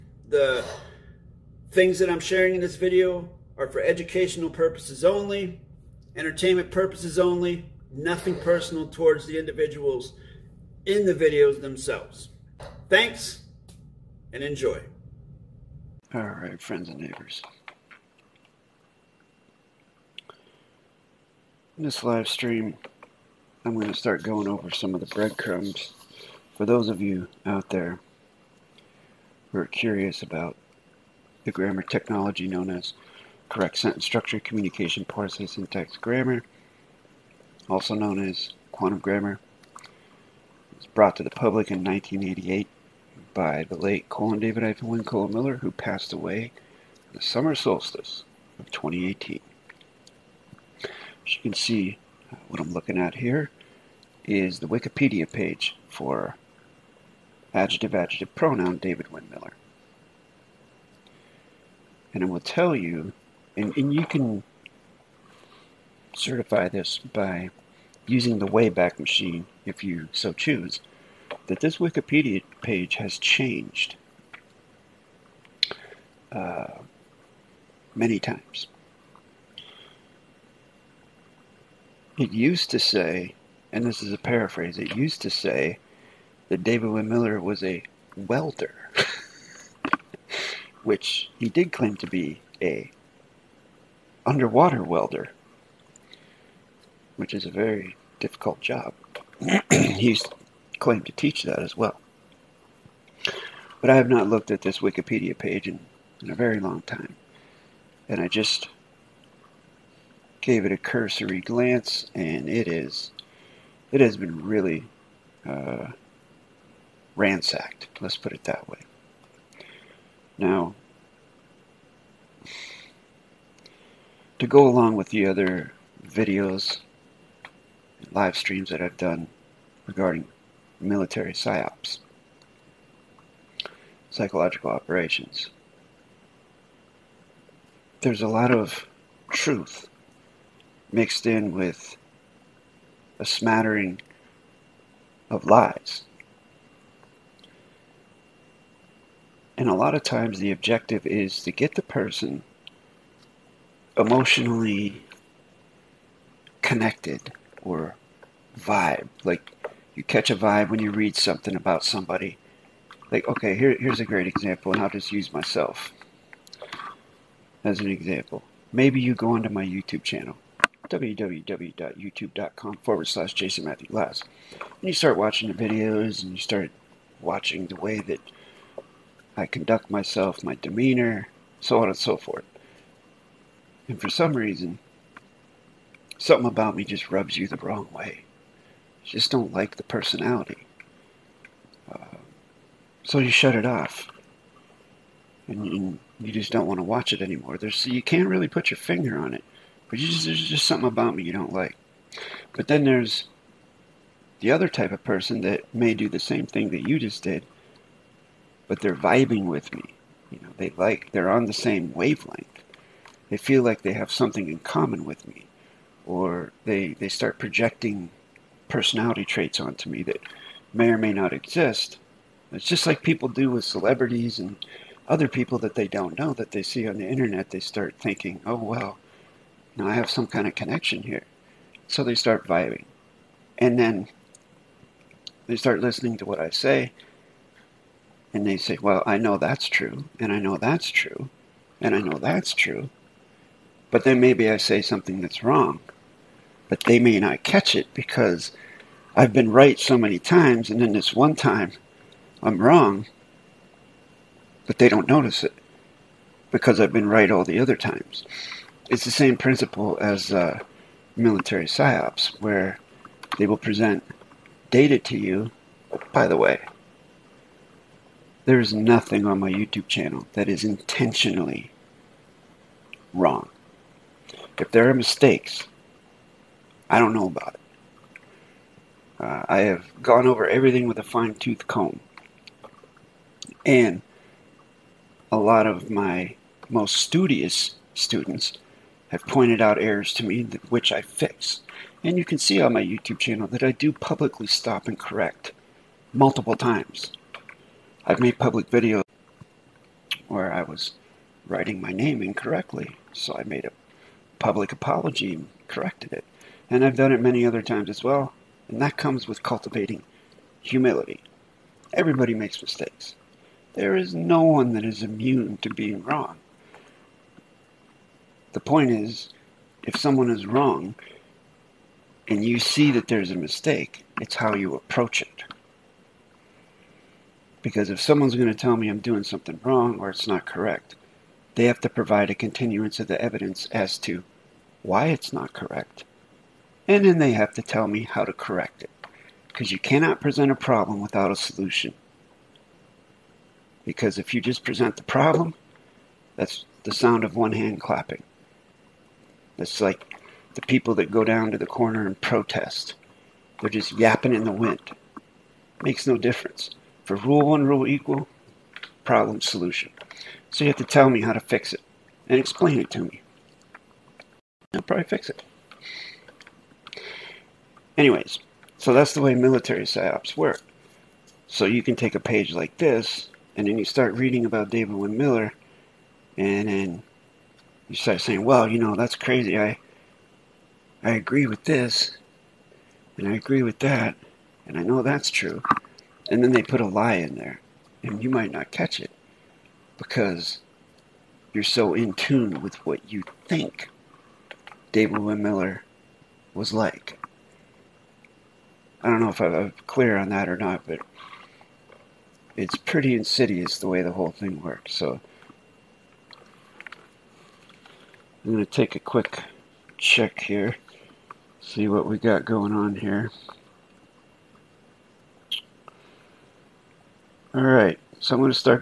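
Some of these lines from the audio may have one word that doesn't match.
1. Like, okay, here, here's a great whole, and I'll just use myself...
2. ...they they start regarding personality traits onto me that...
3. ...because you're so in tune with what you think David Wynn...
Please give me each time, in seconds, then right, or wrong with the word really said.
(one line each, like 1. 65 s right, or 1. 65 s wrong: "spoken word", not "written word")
1. 163 s wrong: "example", not "whole"
2. 216 s wrong: "projecting", not "regarding"
3. 389 s right.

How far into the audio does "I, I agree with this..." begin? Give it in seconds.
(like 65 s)
379 s.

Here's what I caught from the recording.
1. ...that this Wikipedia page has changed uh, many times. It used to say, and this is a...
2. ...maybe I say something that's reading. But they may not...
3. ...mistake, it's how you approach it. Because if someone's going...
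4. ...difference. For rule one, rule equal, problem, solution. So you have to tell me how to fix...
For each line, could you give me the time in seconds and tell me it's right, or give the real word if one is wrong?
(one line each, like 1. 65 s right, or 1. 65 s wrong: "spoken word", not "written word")
1. 71 s right
2. 244 s wrong: "wrong", not "reading"
3. 323 s right
4. 356 s right.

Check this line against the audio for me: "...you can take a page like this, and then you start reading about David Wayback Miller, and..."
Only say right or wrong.
wrong.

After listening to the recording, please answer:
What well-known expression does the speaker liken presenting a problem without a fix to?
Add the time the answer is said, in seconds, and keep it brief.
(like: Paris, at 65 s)
the sound of one hand clapping, at 346 s.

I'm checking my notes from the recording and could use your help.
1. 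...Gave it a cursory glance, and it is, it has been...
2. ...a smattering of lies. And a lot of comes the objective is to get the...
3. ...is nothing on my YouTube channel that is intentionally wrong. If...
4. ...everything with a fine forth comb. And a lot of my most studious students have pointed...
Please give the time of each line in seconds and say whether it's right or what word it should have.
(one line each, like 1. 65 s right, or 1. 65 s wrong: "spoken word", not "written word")
1. 110 s right
2. 143 s wrong: "times", not "comes"
3. 268 s right
4. 280 s wrong: "tooth", not "forth".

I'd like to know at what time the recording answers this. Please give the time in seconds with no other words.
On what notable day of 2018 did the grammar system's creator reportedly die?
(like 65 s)
47 s.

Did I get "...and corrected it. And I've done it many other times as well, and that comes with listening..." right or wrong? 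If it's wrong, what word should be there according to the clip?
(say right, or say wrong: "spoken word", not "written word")
wrong: "cultivating", not "listening".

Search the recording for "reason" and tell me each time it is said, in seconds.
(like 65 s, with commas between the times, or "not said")
184 s.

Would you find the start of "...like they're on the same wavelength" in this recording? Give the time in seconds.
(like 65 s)
210 s.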